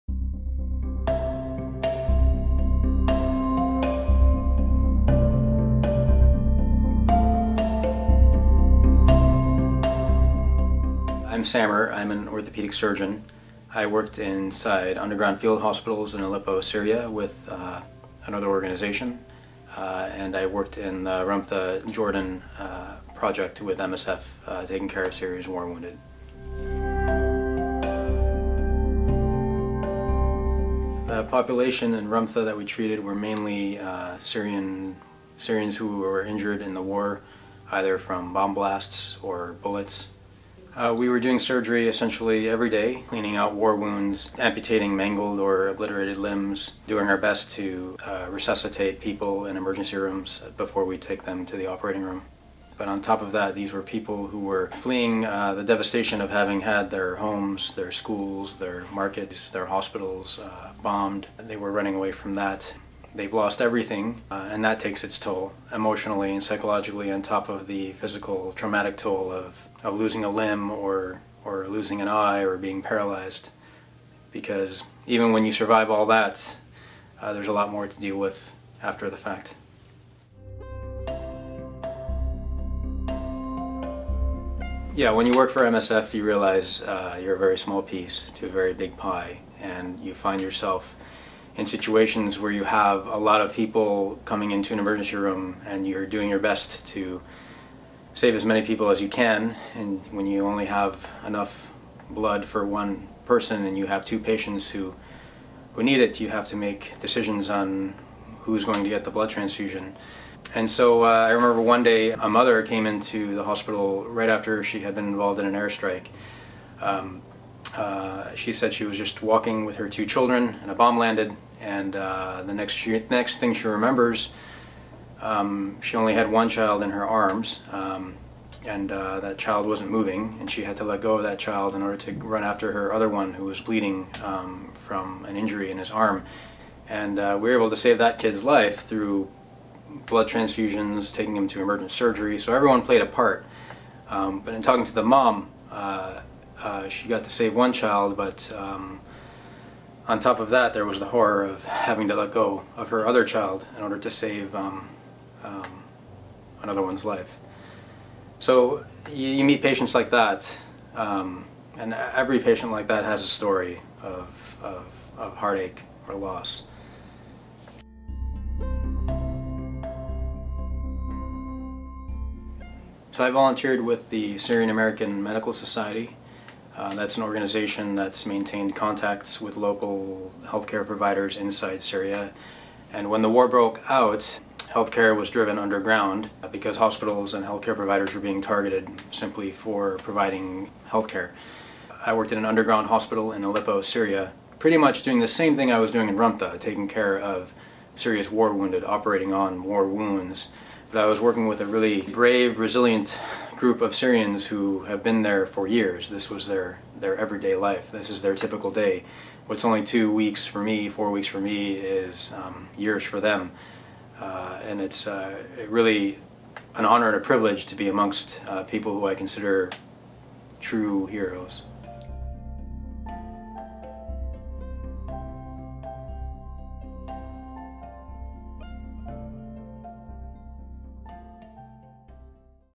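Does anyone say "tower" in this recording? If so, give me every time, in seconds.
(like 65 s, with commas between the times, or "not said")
not said.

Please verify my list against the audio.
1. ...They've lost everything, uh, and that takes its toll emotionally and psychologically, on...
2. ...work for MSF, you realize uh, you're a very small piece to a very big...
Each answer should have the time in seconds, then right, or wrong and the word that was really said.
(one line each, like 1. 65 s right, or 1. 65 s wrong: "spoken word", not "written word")
1. 63 s right
2. 85 s right.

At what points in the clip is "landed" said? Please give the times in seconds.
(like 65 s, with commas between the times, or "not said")
120 s.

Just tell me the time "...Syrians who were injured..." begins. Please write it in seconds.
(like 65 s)
35 s.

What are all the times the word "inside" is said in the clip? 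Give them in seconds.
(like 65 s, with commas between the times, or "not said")
14 s, 181 s.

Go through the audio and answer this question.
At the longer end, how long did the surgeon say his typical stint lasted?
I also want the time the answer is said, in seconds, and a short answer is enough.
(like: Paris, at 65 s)
4 weeks, at 210 s.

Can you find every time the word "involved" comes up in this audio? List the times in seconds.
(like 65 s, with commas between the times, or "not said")
115 s.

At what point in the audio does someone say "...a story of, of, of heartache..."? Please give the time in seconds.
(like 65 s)
163 s.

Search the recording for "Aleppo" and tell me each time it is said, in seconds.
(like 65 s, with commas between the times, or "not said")
16 s, 193 s.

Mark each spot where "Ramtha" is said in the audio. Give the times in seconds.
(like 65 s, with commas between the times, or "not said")
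21 s, 32 s, 196 s.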